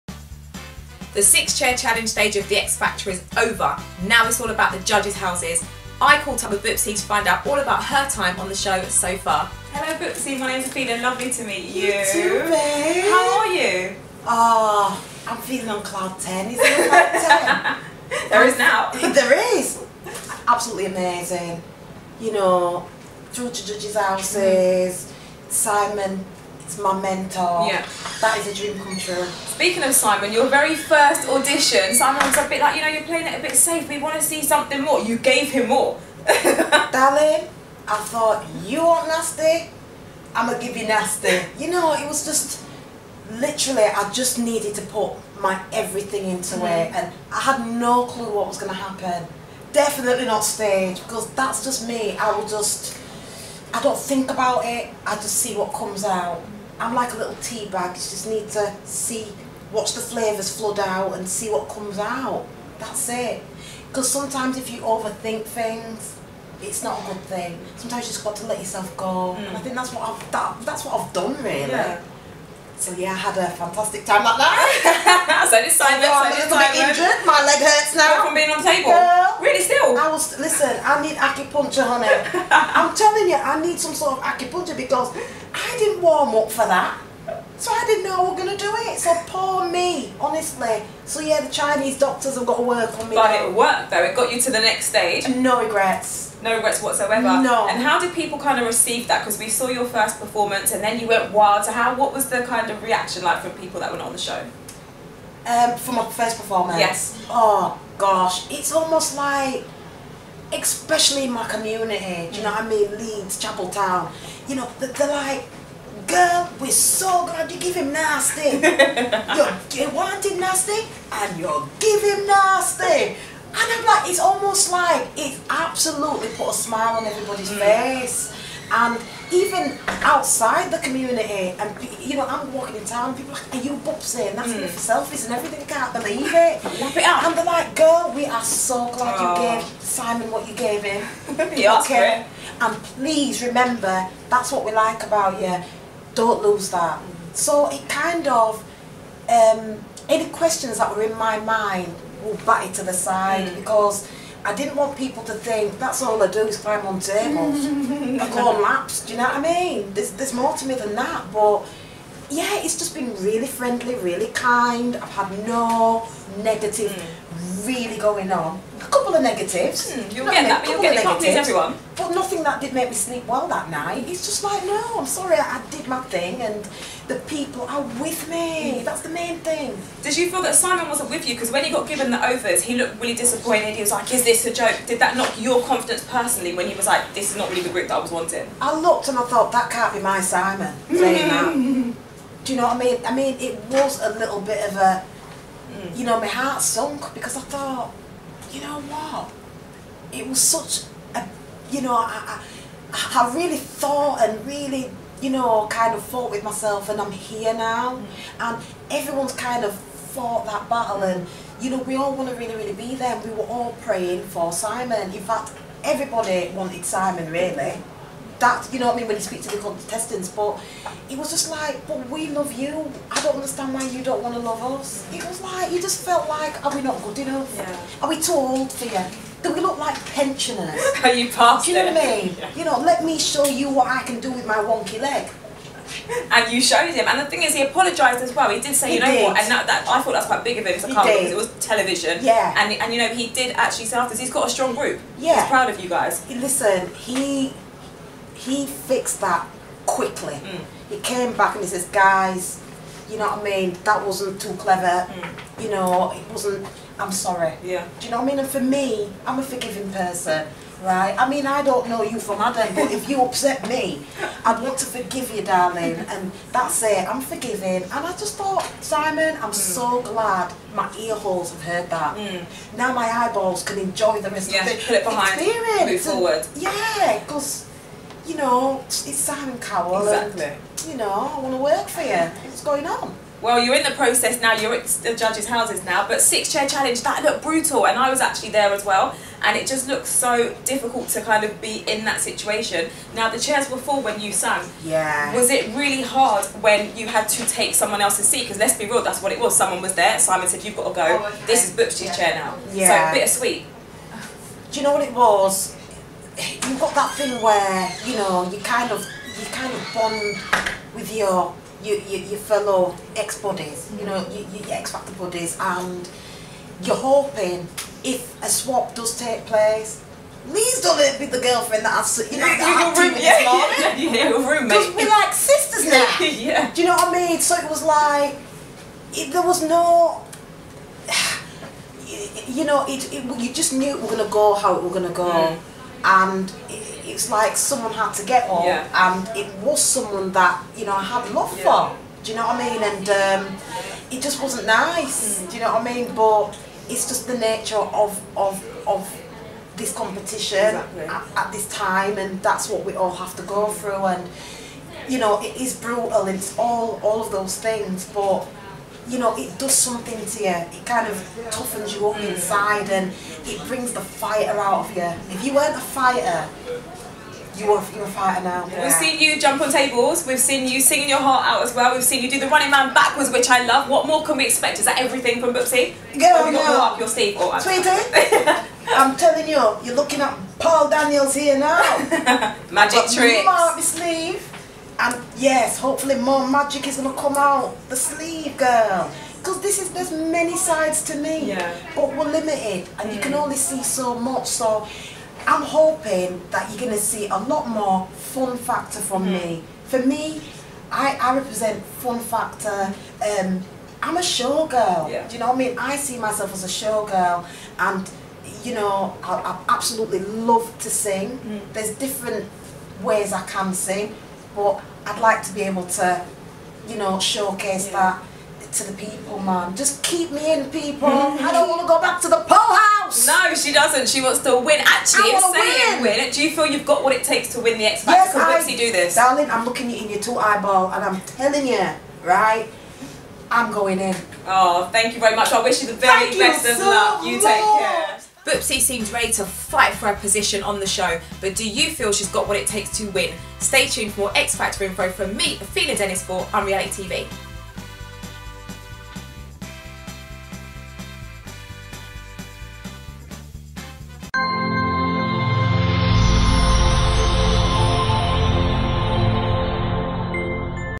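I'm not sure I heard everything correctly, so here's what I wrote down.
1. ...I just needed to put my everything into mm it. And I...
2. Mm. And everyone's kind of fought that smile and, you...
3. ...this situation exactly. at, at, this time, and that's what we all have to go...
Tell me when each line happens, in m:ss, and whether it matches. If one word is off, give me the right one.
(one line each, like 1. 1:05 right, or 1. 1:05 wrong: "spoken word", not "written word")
1. 0:43 right
2. 3:27 wrong: "battle", not "smile"
3. 5:49 wrong: "competition", not "situation".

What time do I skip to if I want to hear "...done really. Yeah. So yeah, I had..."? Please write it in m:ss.
1:11.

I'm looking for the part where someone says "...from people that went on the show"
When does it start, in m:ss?
1:43.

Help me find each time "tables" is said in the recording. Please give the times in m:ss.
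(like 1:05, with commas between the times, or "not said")
1:18, 2:36, 6:09.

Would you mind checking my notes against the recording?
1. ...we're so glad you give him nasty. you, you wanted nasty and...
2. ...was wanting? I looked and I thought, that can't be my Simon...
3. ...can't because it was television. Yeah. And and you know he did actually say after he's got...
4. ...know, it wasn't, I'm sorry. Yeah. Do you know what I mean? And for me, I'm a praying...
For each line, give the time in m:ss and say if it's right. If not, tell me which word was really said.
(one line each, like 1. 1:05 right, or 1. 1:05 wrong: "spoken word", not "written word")
1. 1:56 right
2. 3:07 right
3. 4:00 right
4. 4:15 wrong: "forgiving", not "praying".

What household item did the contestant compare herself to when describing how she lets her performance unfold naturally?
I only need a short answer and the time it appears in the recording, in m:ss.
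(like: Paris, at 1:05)
Tea bag, at 0:57.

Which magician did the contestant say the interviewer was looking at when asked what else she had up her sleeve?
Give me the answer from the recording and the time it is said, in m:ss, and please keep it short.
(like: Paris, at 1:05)
Paul Daniels, at 6:20.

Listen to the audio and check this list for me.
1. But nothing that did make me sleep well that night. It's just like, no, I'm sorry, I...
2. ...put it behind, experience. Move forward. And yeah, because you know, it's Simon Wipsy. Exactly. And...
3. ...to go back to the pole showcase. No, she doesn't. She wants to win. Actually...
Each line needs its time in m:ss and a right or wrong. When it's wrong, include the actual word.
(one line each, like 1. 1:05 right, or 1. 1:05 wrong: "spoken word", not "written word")
1. 2:51 right
2. 4:34 wrong: "Cowell", not "Wipsy"
3. 7:01 wrong: "house", not "showcase".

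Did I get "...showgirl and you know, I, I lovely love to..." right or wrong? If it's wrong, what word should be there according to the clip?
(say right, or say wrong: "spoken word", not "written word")
wrong: "absolutely", not "lovely".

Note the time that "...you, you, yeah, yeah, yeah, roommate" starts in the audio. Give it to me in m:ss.
5:23.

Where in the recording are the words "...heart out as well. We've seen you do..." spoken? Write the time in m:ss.
6:11.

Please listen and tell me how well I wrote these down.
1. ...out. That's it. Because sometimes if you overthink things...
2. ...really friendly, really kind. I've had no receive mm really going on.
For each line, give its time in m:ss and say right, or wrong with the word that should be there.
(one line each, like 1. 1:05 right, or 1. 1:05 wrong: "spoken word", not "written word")
1. 1:01 right
2. 2:43 wrong: "negative", not "receive".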